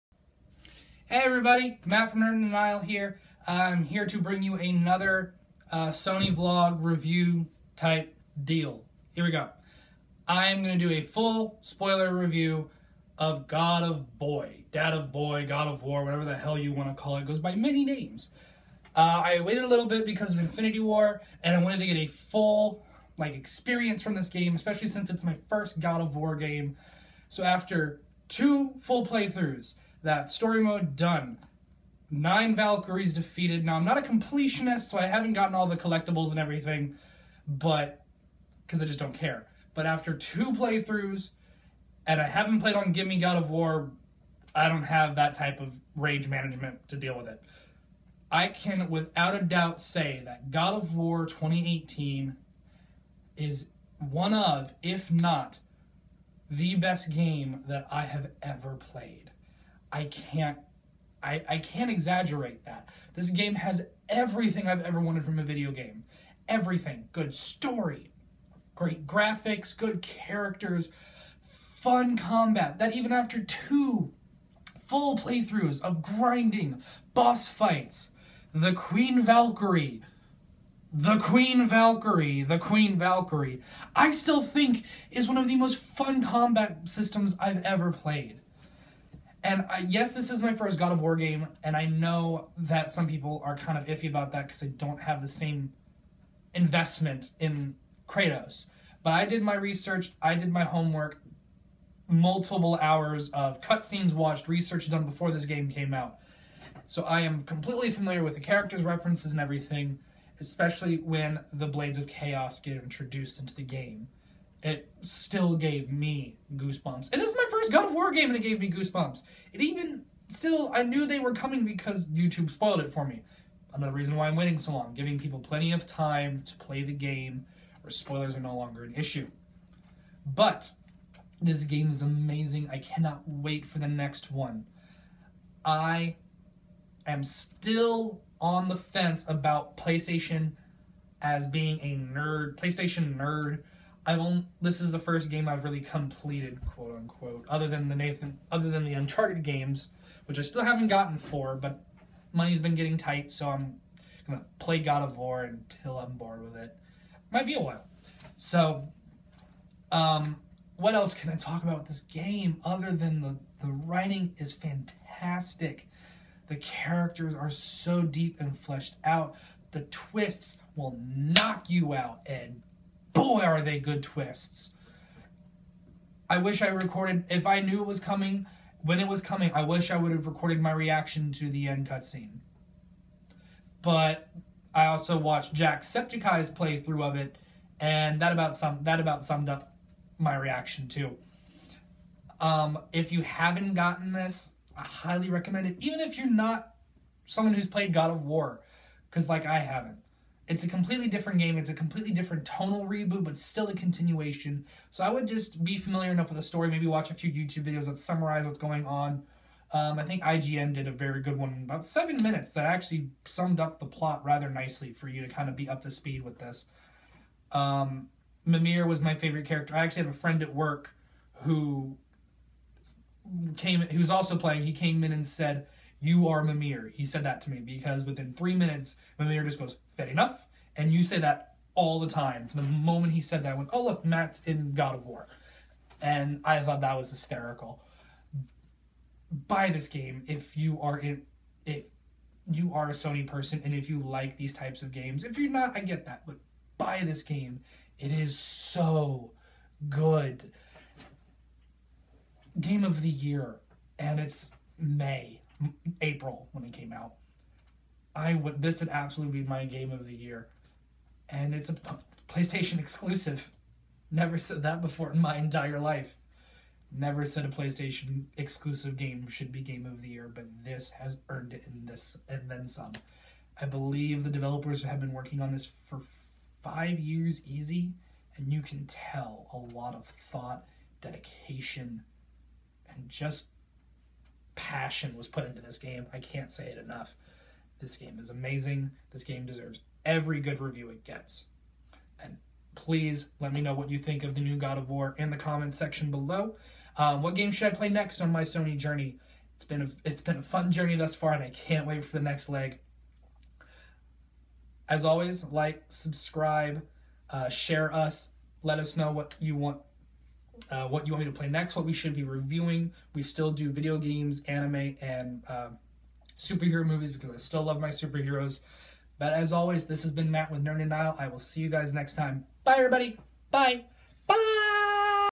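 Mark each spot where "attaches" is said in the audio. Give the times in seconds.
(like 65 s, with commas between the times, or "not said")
not said.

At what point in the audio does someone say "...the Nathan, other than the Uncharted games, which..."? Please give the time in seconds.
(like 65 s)
147 s.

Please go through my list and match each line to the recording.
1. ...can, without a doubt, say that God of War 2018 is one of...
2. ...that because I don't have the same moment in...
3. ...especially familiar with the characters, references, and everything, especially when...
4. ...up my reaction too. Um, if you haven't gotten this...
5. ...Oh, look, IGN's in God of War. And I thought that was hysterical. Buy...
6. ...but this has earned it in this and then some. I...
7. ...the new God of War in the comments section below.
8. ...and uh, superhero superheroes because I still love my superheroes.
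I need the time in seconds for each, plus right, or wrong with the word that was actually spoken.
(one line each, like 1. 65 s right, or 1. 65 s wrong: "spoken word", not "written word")
1. 48 s right
2. 94 s wrong: "investment", not "moment"
3. 107 s wrong: "completely", not "especially"
4. 189 s right
5. 233 s wrong: "Matt", not "IGN"
6. 270 s right
7. 294 s right
8. 315 s wrong: "movies", not "superheroes".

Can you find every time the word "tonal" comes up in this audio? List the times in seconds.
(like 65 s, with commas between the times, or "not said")
202 s.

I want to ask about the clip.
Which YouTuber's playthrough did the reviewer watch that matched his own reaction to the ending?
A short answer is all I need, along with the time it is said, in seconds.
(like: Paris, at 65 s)
Jacksepticeye, at 185 s.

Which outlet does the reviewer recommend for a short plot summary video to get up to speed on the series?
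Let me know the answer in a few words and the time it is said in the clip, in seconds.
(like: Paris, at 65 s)
IGN, at 210 s.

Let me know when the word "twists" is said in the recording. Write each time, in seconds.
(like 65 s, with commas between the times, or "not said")
169 s, 174 s.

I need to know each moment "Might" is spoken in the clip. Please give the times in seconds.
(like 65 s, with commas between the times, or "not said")
157 s.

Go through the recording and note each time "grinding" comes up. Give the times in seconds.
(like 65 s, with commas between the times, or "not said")
76 s.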